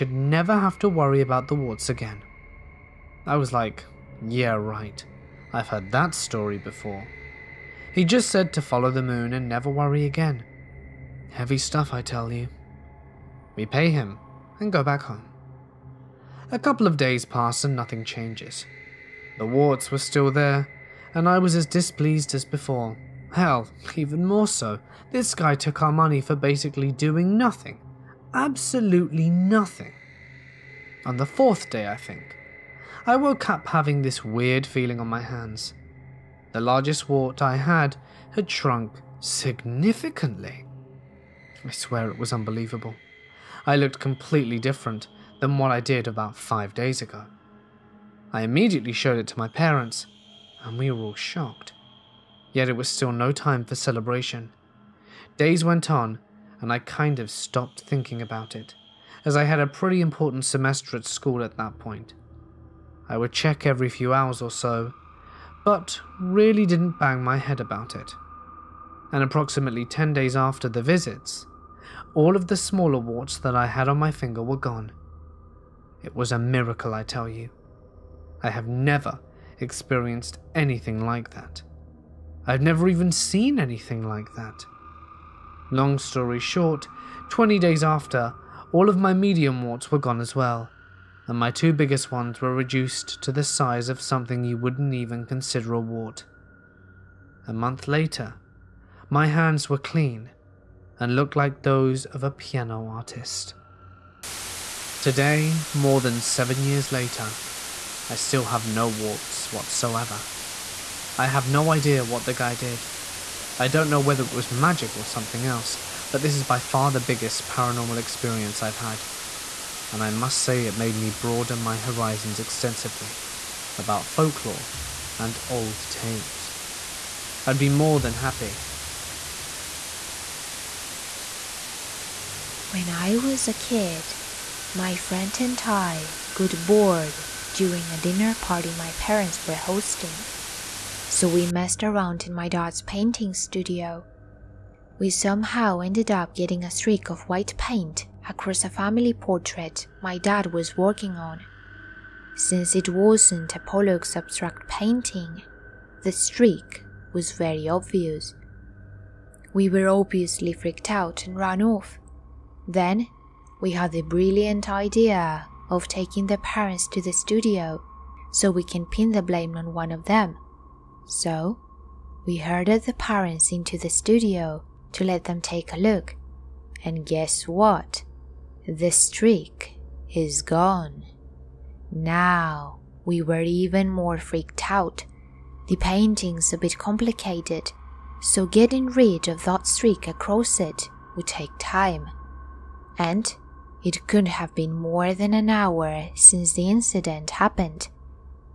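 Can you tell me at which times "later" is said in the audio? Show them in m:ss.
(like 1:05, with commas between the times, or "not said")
1:37, 1:46.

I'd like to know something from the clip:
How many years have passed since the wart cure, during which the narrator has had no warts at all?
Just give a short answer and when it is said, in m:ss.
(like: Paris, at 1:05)
7 years, at 1:46.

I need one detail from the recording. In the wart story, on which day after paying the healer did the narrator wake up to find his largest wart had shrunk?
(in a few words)
4th day.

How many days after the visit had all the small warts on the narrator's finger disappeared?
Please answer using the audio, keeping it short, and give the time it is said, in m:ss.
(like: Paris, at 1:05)
10 days, at 1:09.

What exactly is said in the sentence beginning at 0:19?
The warts were still there, and I was as displeased as before.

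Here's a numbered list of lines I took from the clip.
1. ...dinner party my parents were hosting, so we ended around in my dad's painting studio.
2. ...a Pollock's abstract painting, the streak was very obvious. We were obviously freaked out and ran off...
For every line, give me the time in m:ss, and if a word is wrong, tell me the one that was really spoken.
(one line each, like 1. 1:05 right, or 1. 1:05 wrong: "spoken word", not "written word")
1. 2:17 wrong: "messed", not "ended"
2. 2:33 right.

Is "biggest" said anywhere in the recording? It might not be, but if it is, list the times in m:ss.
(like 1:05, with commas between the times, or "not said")
1:31, 1:57.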